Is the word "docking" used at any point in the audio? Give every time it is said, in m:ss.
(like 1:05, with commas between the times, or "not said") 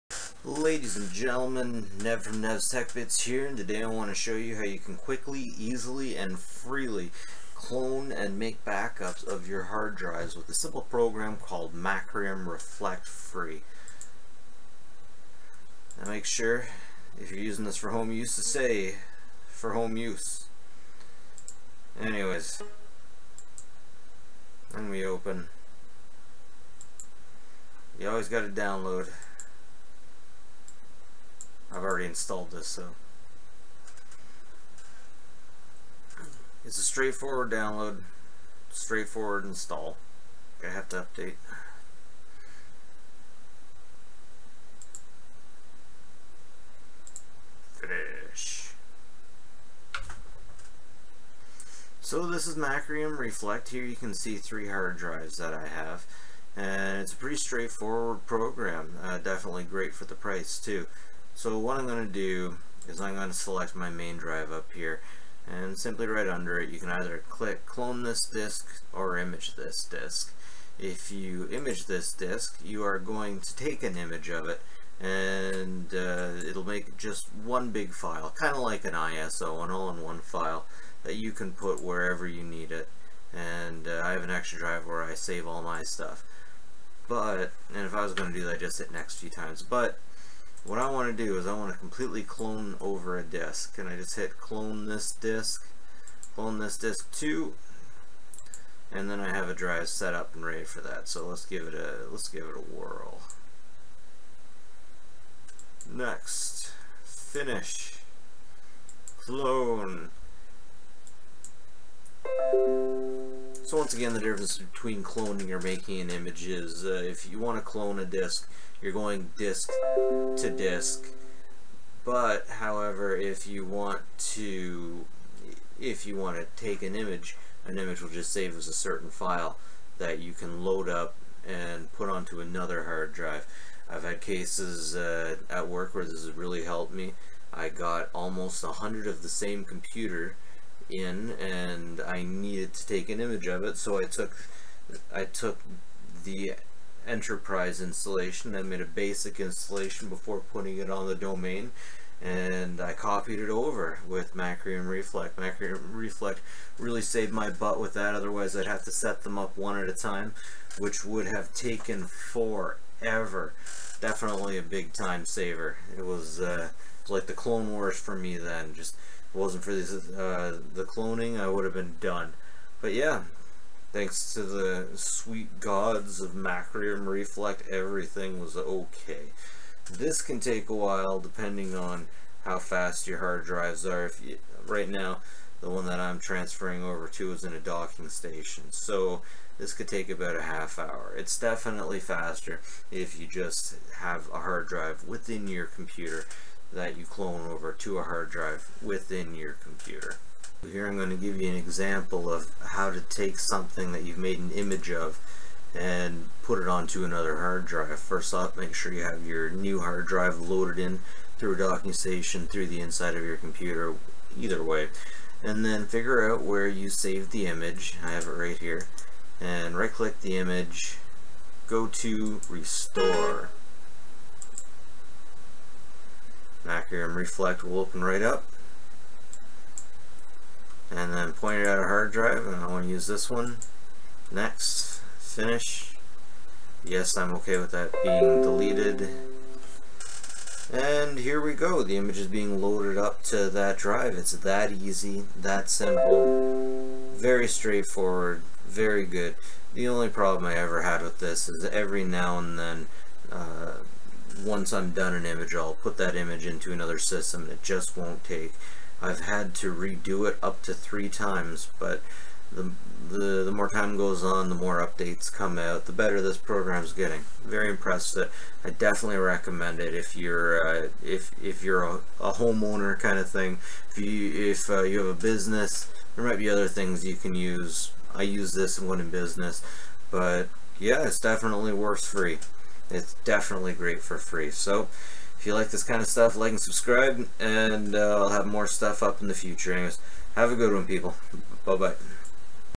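3:07, 3:31.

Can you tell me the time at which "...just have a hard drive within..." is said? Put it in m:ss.
3:13.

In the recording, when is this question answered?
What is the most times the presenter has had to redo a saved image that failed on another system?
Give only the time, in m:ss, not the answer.
4:20.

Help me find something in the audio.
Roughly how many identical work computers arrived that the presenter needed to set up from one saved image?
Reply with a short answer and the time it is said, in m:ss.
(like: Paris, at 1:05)
almost 100, at 2:18.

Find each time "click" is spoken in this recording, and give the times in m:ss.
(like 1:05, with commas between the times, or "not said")
1:07, 3:39.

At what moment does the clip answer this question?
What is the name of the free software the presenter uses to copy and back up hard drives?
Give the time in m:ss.
0:11.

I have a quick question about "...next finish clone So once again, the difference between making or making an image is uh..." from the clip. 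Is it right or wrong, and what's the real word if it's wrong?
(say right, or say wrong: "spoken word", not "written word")
wrong: "cloning", not "making".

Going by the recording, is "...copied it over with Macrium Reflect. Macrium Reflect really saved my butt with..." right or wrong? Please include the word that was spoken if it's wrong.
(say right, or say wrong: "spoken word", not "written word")
right.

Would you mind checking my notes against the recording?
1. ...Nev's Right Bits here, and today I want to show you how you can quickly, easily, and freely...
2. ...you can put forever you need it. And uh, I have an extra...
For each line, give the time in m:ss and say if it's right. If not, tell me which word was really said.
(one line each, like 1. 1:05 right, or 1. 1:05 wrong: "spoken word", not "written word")
1. 0:02 wrong: "Tech", not "Right"
2. 1:21 wrong: "wherever", not "forever".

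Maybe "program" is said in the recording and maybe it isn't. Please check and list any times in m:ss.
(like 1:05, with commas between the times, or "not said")
0:10, 0:58, 4:26.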